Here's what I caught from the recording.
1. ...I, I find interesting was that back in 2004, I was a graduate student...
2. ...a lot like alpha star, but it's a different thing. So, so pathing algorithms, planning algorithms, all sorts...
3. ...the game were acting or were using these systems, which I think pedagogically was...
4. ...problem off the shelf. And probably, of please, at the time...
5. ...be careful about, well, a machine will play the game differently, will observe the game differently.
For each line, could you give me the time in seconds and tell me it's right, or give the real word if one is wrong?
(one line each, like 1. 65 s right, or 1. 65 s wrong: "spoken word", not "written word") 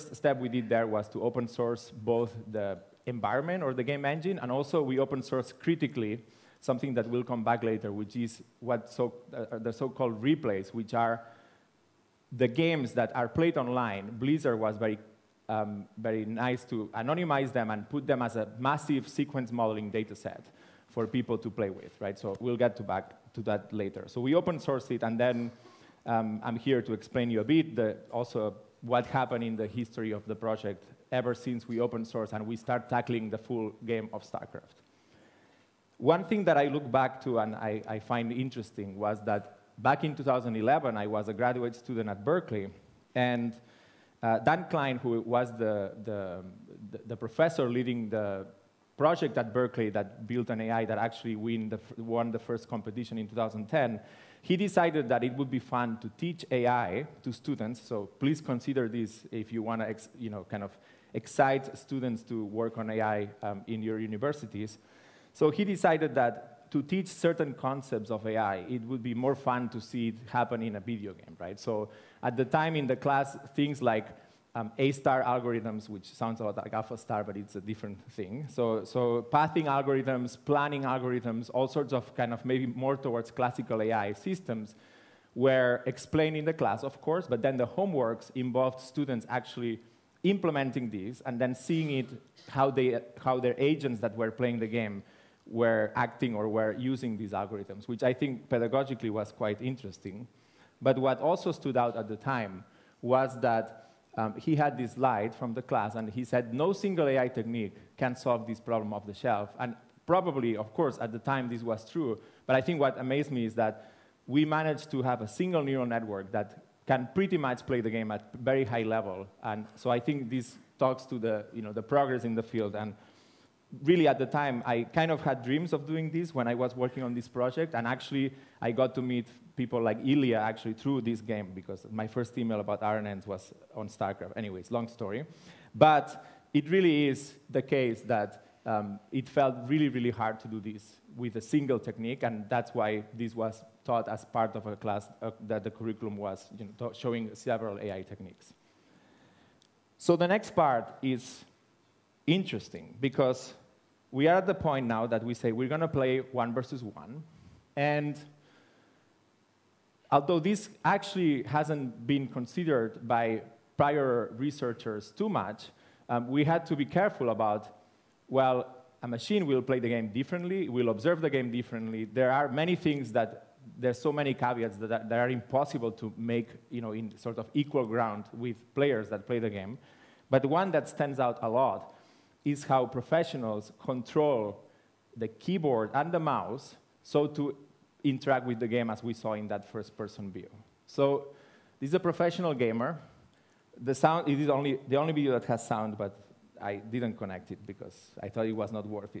1. 37 s wrong: "2011", not "2004"
2. 76 s right
3. 94 s wrong: "algorithms", not "systems"
4. 108 s wrong: "course", not "please"
5. 166 s right.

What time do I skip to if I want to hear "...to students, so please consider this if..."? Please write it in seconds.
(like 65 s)
57 s.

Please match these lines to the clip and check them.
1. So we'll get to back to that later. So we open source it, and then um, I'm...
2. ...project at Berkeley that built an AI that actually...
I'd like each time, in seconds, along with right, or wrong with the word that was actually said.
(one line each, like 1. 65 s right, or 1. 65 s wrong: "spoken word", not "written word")
1. 22 s right
2. 48 s right.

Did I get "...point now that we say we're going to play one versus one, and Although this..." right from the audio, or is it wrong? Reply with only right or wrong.
right.